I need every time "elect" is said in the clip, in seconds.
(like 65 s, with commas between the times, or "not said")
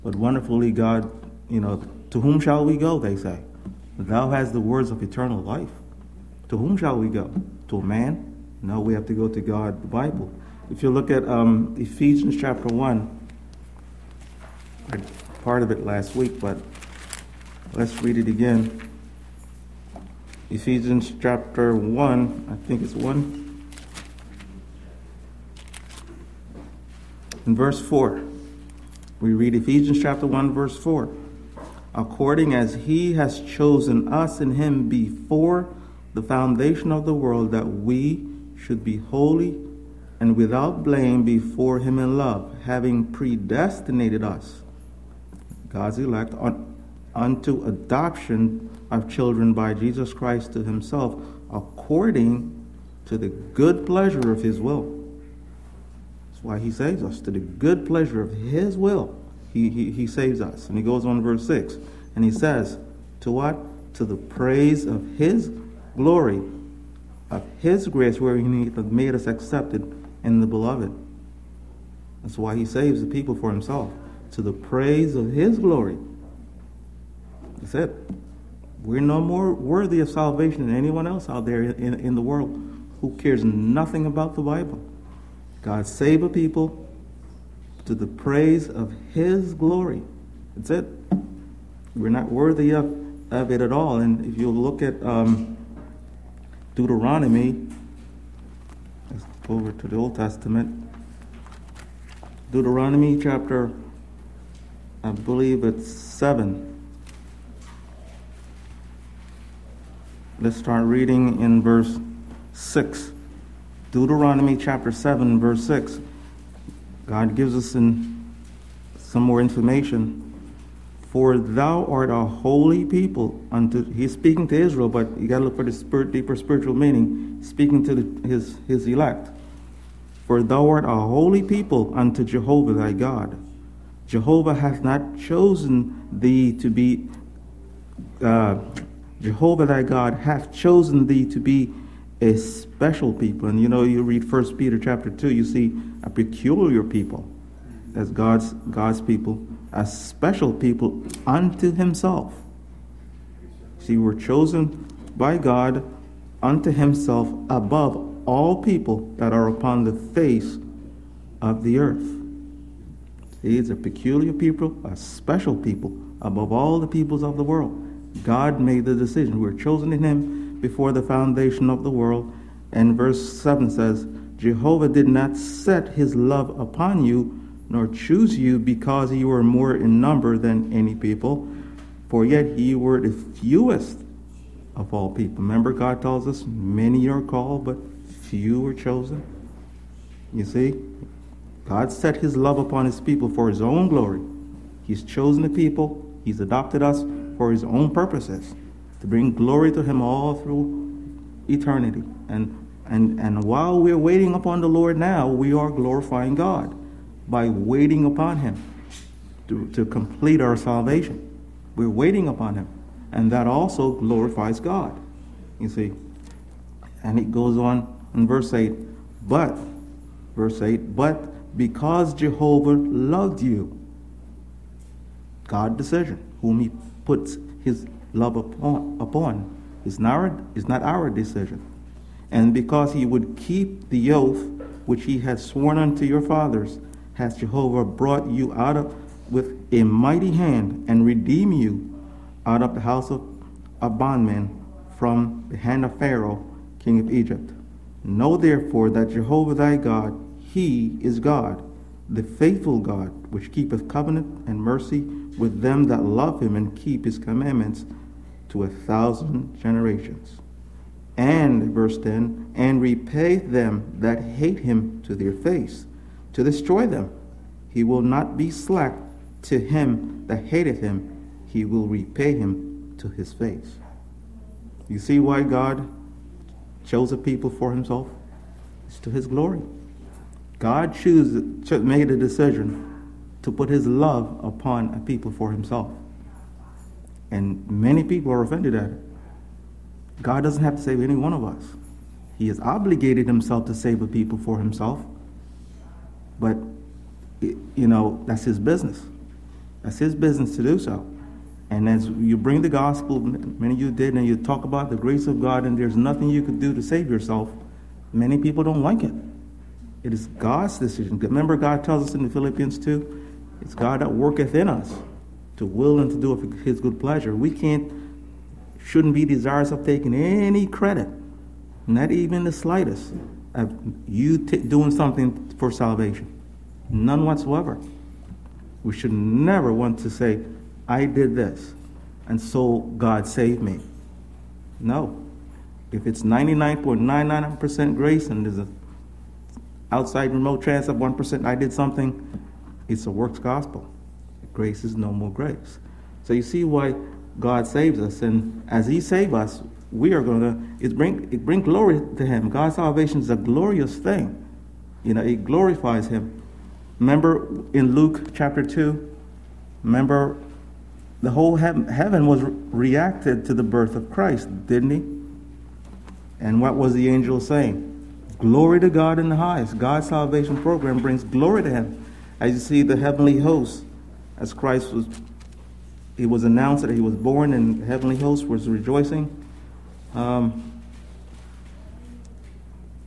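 45 s, 128 s.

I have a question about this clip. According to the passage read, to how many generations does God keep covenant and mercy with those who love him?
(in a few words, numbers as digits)
1,000.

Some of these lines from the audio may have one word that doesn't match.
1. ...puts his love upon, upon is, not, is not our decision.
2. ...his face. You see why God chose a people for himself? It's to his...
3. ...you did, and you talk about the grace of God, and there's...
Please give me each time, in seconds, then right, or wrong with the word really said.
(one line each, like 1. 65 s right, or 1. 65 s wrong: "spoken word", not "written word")
1. 227 s right
2. 273 s right
3. 303 s right.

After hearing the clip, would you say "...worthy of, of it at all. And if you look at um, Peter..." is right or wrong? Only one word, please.
wrong.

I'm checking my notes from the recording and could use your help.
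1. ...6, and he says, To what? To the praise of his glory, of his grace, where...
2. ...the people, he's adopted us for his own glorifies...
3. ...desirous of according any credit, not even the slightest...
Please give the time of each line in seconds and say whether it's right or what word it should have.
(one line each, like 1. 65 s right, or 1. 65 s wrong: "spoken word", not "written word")
1. 61 s right
2. 195 s wrong: "purposes", not "glorifies"
3. 319 s wrong: "taking", not "according".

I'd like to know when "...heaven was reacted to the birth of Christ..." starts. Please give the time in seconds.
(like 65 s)
361 s.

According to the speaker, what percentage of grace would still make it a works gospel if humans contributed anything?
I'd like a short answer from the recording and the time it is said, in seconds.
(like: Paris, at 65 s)
99.99%, at 336 s.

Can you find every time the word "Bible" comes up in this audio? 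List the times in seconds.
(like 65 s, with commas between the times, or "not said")
9 s, 84 s.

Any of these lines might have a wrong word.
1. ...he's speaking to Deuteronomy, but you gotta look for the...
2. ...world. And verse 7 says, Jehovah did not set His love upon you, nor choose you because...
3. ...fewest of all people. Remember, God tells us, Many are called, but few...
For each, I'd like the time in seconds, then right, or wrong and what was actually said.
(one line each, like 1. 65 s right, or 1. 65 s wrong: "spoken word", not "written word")
1. 123 s wrong: "Israel", not "Deuteronomy"
2. 171 s right
3. 183 s right.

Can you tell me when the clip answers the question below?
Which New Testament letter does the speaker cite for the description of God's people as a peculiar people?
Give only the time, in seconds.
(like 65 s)
144 s.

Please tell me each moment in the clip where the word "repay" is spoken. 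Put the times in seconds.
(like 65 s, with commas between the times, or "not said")
262 s, 271 s.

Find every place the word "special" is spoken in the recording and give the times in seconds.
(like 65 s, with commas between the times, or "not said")
142 s, 149 s, 164 s.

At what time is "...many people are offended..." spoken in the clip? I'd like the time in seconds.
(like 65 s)
287 s.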